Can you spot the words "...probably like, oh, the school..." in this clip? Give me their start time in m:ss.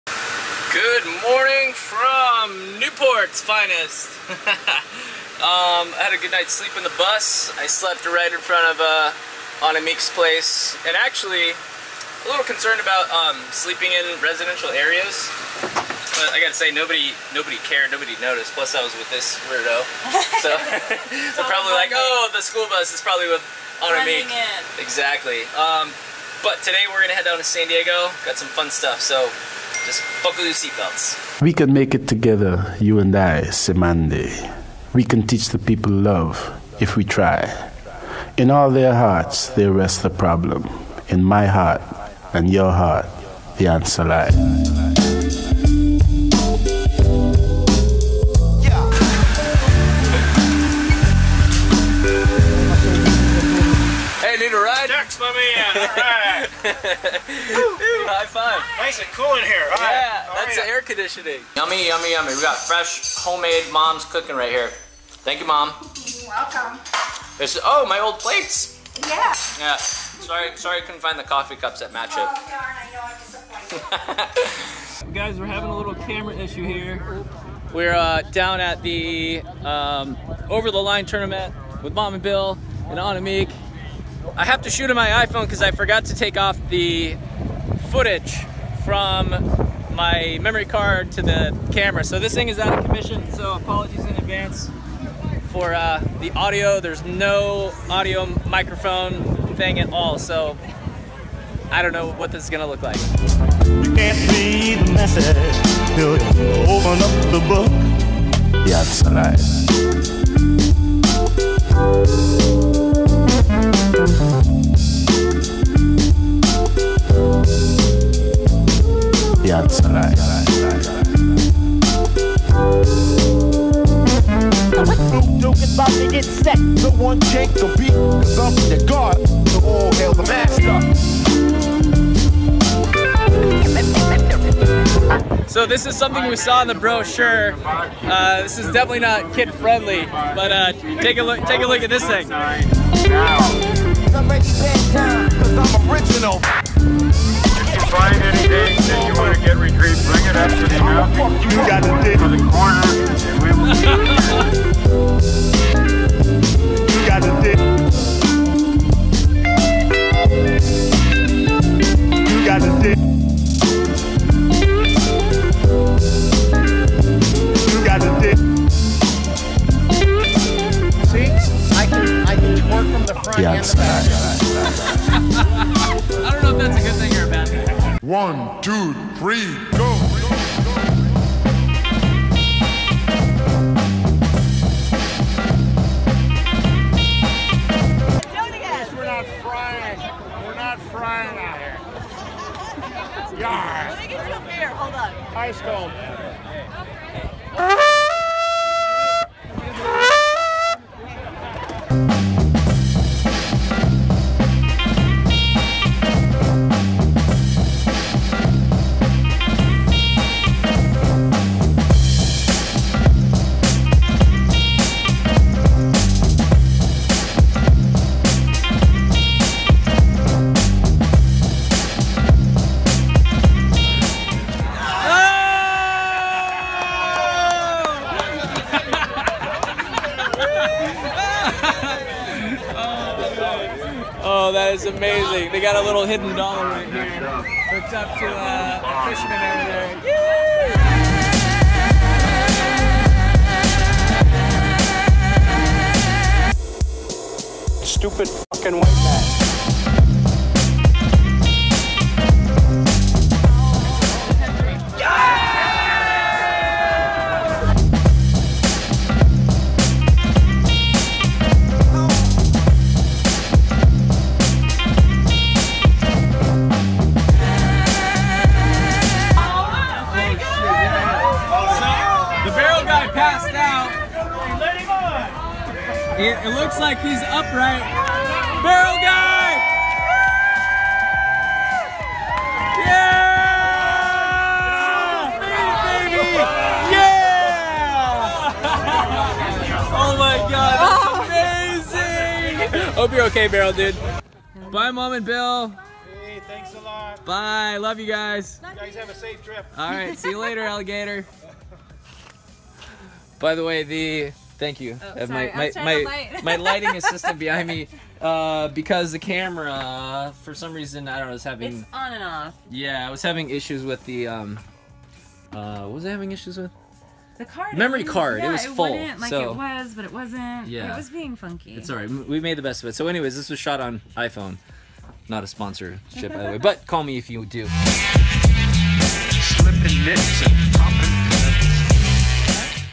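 0:21.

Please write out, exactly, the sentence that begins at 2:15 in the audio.
So this is something we saw in the brochure.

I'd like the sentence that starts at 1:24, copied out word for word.
I have to shoot on my iPhone because I forgot to take off the footage from my memory card to the camera.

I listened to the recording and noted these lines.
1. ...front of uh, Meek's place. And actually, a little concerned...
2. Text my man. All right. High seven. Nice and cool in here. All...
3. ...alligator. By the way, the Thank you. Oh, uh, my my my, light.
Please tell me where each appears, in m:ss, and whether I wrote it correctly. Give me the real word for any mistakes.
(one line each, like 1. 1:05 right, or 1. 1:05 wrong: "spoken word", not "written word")
1. 0:08 right
2. 0:54 wrong: "five", not "seven"
3. 5:00 right.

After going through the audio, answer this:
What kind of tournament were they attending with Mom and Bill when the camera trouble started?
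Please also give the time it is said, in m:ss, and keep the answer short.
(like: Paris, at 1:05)
over the line, at 1:20.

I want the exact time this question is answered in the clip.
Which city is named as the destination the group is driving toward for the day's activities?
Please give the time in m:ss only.
0:27.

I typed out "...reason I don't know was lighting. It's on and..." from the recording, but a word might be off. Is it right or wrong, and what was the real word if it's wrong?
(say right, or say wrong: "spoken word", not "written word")
wrong: "having", not "lighting".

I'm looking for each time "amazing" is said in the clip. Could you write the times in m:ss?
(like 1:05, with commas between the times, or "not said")
3:54, 4:52.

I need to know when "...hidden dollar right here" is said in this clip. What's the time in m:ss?
3:56.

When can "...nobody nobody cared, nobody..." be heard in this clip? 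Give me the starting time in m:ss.
0:16.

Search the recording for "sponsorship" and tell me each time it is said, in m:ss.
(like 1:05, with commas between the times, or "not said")
5:25.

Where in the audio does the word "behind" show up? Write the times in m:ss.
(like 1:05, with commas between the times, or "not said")
5:07.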